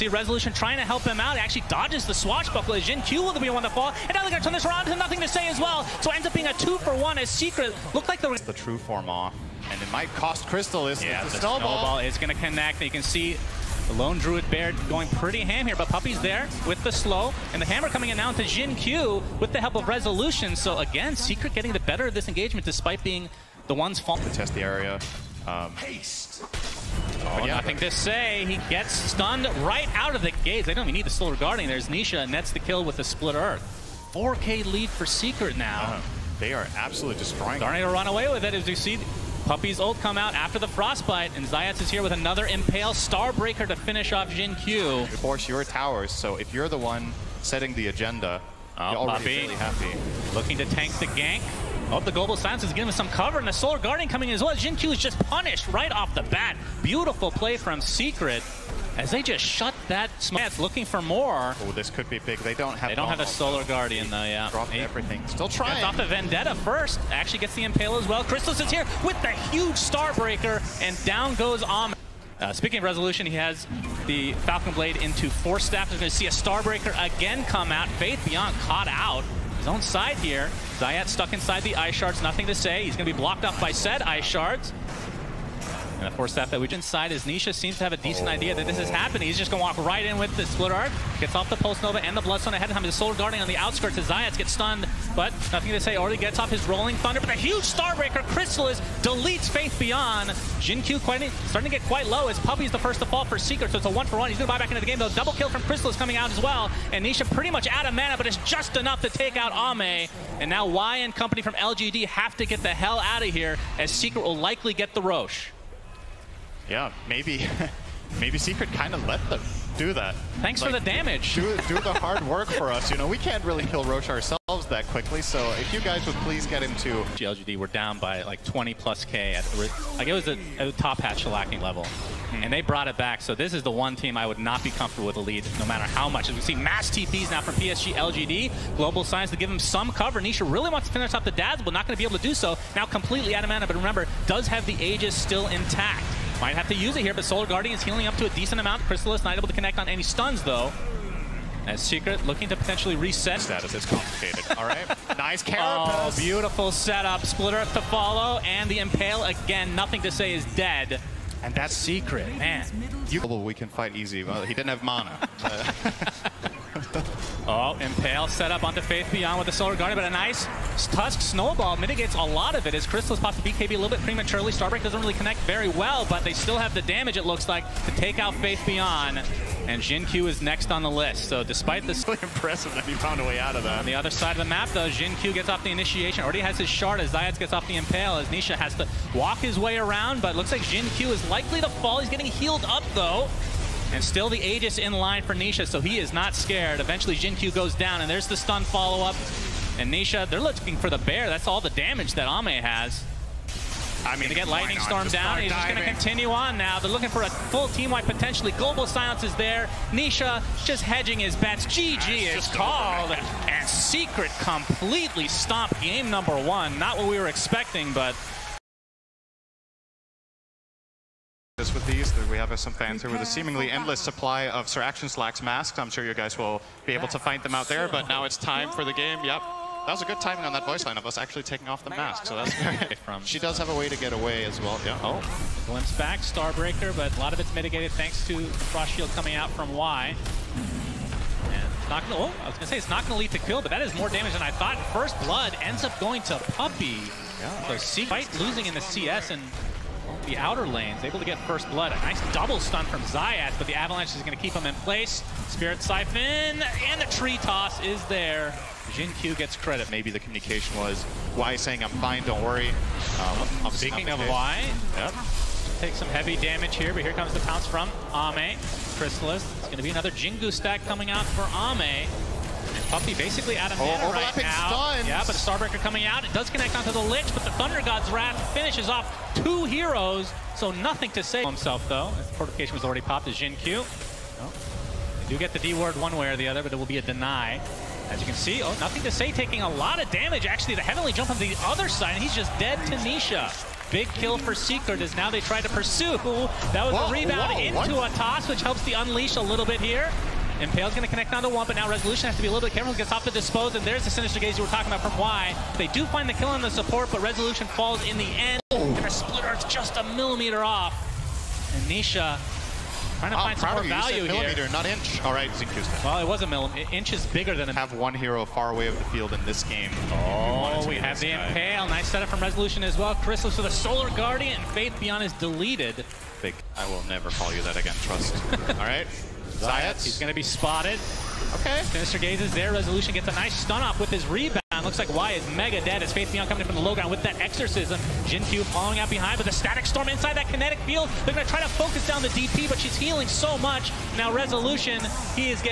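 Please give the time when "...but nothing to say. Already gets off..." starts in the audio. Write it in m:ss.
1:35.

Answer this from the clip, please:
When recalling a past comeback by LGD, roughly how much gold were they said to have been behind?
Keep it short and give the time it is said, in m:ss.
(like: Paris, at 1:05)
20+ K, at 2:08.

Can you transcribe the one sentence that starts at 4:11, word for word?
A nice double stun from Zayat, but the Avalanche is going to keep him in place.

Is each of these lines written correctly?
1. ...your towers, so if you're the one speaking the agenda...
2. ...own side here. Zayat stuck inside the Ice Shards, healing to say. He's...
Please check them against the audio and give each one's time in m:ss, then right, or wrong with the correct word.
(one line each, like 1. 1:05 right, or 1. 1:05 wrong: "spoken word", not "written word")
1. 0:45 wrong: "setting", not "speaking"
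2. 1:19 wrong: "nothing", not "healing".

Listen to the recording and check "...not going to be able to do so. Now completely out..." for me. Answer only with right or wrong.
right.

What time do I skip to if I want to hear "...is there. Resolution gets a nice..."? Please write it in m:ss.
5:32.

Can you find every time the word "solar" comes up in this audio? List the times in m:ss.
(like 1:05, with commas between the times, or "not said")
0:31, 0:53, 1:03, 1:32, 2:27, 2:49, 5:23.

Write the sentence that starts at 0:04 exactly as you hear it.
And now they're going to turn this around to nothing to say as well.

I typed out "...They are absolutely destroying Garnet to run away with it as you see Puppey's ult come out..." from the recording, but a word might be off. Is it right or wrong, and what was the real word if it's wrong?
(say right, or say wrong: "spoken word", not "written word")
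right.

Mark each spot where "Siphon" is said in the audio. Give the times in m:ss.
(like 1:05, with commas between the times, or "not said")
4:15.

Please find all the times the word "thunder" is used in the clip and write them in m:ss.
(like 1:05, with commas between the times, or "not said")
1:36, 4:37.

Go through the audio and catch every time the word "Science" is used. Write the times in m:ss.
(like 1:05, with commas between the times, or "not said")
0:52.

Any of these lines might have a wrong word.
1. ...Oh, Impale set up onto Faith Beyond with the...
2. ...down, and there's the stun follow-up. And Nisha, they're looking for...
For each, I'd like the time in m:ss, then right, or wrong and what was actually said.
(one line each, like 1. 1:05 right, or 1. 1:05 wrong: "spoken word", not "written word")
1. 2:47 right
2. 3:17 right.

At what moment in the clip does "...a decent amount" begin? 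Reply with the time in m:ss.
2:28.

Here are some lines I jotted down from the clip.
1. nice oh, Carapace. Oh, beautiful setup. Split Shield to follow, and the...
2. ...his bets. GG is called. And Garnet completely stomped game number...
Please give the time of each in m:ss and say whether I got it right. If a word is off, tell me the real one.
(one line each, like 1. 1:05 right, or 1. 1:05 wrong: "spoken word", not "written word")
1. 2:35 wrong: "Earth", not "Shield"
2. 3:31 wrong: "Secret", not "Garnet".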